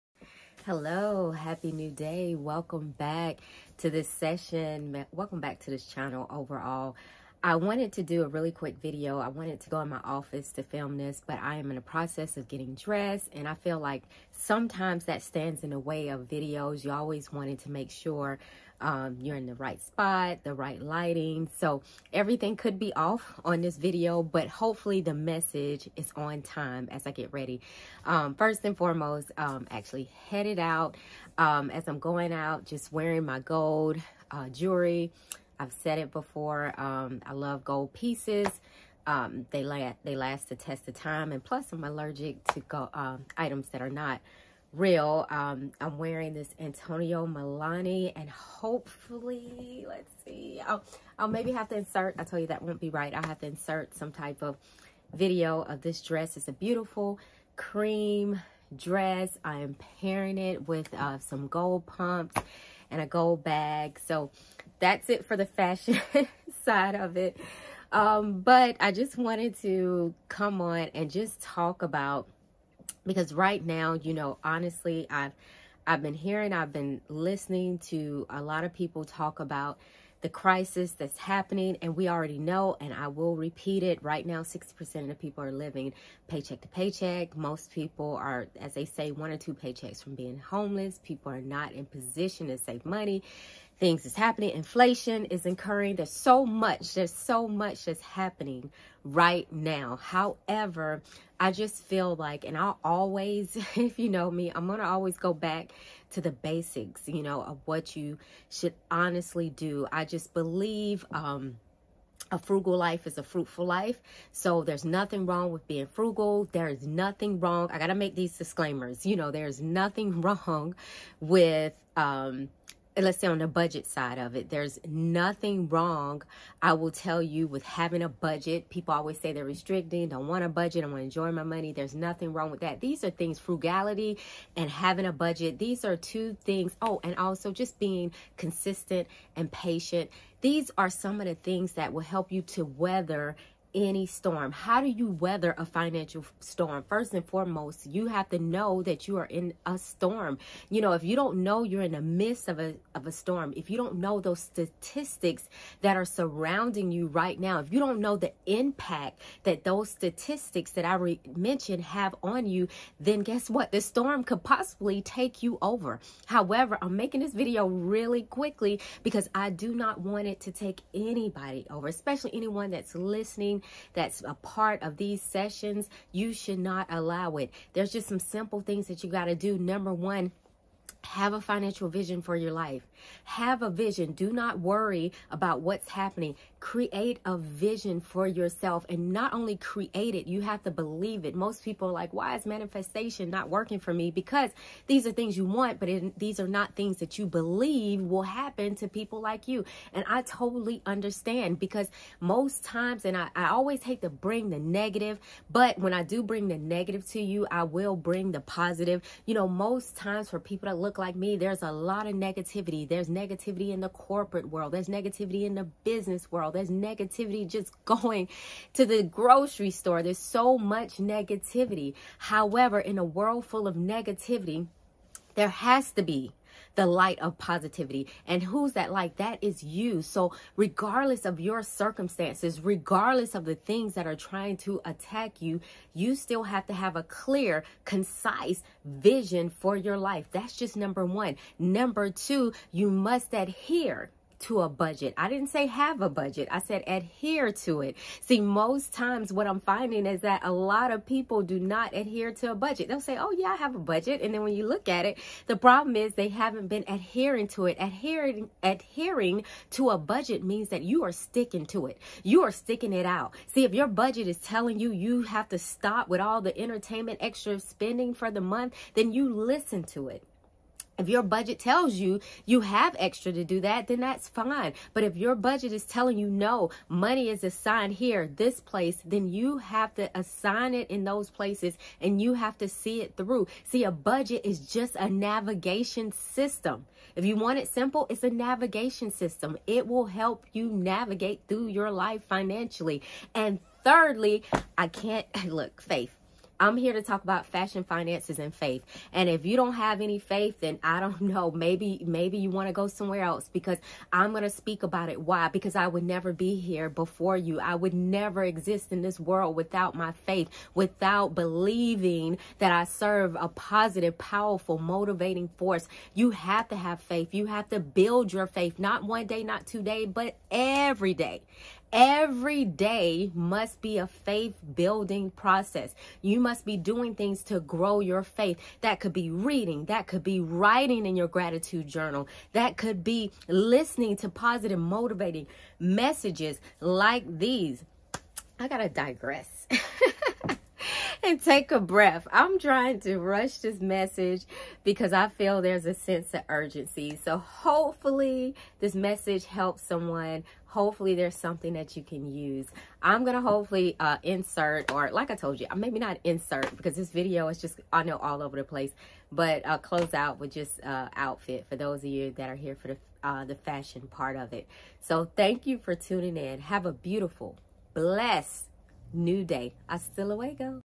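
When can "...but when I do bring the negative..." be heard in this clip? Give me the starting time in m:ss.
3:25.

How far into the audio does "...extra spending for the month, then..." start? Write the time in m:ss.
4:27.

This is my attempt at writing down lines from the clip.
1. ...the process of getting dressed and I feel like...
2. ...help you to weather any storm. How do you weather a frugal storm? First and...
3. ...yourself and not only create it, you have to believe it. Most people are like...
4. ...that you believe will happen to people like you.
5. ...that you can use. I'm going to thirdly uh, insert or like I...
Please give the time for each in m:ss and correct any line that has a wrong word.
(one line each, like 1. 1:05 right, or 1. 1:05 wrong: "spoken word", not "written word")
1. 0:11 right
2. 2:22 wrong: "financial", not "frugal"
3. 3:08 right
4. 3:16 right
5. 5:51 wrong: "hopefully", not "thirdly".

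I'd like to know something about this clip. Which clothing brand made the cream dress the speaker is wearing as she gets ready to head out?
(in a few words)
Antonio Melani.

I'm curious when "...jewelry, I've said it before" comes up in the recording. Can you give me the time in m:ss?
0:34.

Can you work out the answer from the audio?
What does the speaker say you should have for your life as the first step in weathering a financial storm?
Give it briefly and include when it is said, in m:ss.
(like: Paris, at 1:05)
A financial vision, at 3:01.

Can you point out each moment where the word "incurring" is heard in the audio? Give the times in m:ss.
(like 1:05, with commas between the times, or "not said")
1:35.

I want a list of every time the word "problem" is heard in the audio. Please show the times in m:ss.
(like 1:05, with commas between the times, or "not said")
4:15.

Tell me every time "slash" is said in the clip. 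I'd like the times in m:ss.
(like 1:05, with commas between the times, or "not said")
not said.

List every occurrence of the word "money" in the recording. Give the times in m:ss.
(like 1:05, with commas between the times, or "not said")
1:32, 2:11, 4:36.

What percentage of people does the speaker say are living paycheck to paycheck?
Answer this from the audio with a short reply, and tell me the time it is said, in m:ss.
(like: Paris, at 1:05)
60%, at 1:24.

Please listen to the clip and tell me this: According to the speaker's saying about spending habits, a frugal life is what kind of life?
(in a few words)
A fruitful life.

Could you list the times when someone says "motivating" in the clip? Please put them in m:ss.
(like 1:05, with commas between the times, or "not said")
5:14, 5:34.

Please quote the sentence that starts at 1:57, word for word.
I got to make these disclaimers.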